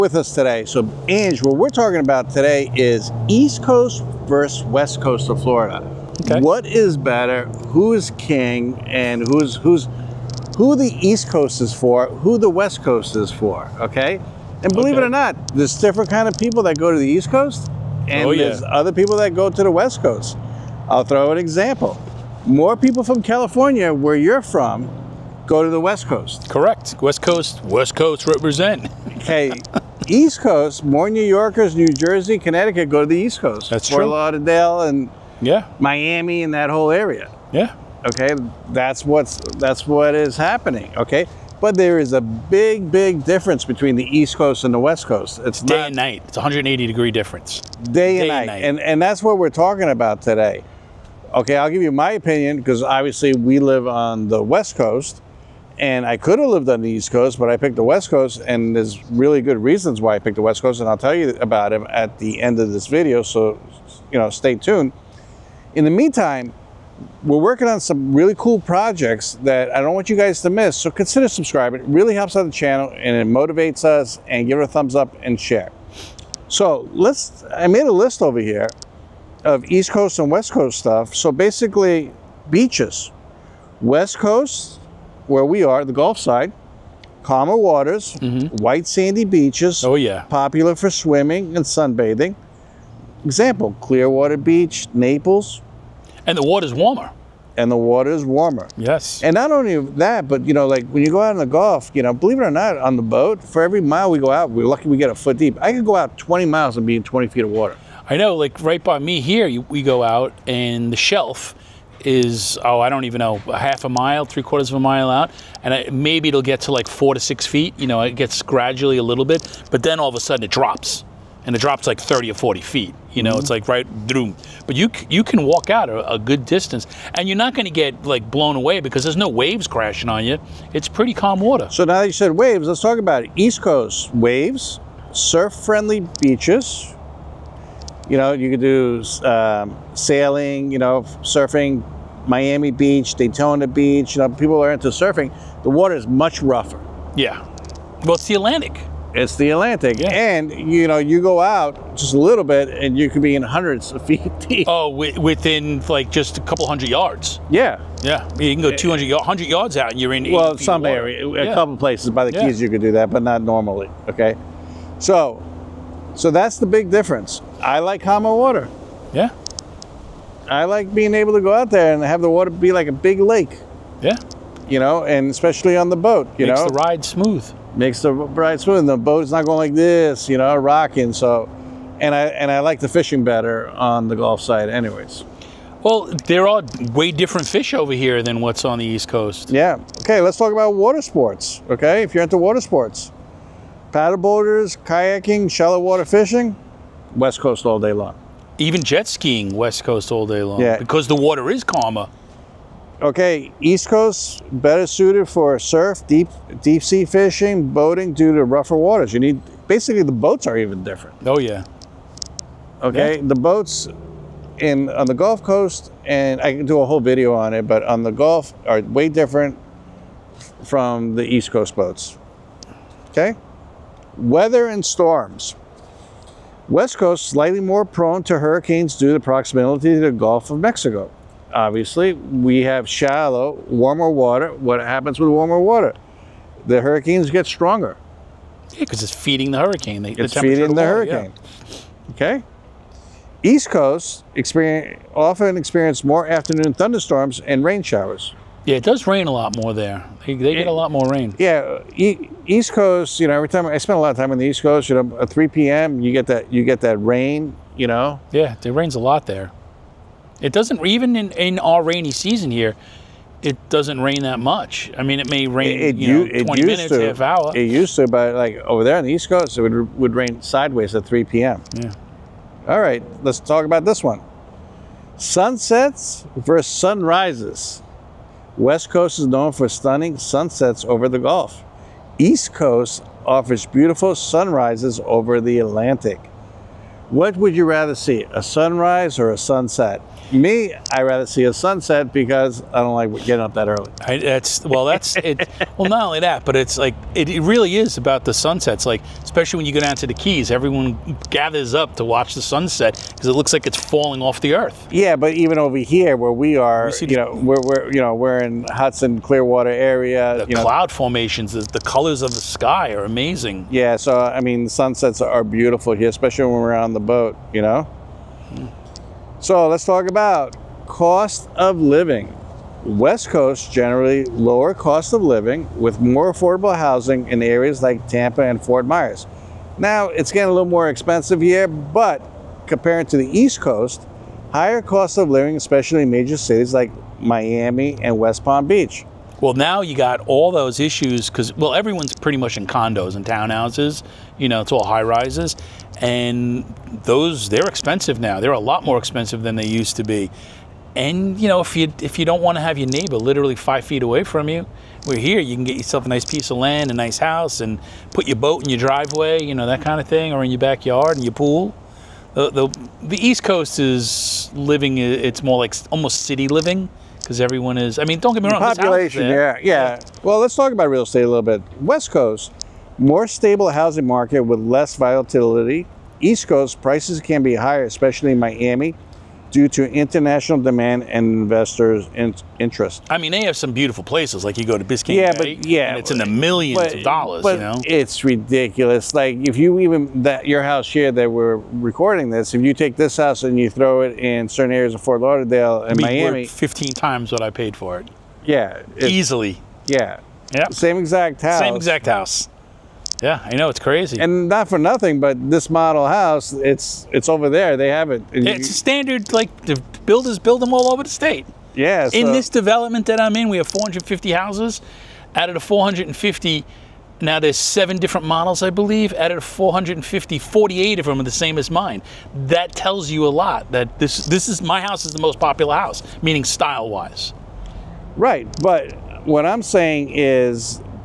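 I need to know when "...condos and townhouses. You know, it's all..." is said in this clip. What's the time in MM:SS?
05:42.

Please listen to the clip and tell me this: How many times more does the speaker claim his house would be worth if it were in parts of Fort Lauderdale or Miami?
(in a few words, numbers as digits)
15 times.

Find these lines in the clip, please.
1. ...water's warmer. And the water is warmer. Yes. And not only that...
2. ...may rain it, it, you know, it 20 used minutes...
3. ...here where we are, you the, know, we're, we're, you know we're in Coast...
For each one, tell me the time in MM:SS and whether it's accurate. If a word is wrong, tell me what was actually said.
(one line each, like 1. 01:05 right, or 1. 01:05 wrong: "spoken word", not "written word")
1. 01:36 right
2. 04:25 right
3. 05:05 wrong: "Hudson", not "Coast".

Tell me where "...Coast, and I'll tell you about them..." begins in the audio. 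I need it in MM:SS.
01:00.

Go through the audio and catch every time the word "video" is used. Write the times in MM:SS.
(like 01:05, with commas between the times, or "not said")
01:02, 03:37.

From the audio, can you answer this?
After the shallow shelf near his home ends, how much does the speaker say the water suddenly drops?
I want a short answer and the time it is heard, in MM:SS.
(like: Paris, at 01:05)
30 or 40 feet, at 02:01.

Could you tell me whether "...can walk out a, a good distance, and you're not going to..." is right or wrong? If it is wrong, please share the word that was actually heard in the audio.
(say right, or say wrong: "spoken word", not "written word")
right.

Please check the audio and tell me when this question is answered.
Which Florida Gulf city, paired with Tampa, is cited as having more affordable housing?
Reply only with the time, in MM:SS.
05:28.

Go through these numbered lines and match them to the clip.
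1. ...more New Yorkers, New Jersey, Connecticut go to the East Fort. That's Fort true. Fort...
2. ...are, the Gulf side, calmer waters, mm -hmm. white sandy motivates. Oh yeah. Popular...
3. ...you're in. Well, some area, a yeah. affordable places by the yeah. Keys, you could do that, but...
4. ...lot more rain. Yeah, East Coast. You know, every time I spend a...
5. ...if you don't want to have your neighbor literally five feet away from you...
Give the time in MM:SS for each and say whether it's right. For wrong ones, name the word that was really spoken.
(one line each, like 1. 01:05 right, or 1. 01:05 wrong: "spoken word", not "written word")
1. 00:30 wrong: "Coast", not "Fort"
2. 01:25 wrong: "beaches", not "motivates"
3. 02:40 wrong: "couple", not "affordable"
4. 04:10 right
5. 05:52 right.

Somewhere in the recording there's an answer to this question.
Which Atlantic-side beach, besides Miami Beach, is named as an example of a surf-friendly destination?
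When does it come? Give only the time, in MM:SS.
02:23.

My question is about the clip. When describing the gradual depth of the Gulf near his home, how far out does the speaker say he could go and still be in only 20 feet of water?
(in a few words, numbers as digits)
20 miles.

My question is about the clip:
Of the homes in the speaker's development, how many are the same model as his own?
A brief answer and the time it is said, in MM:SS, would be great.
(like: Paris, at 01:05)
48, at 07:00.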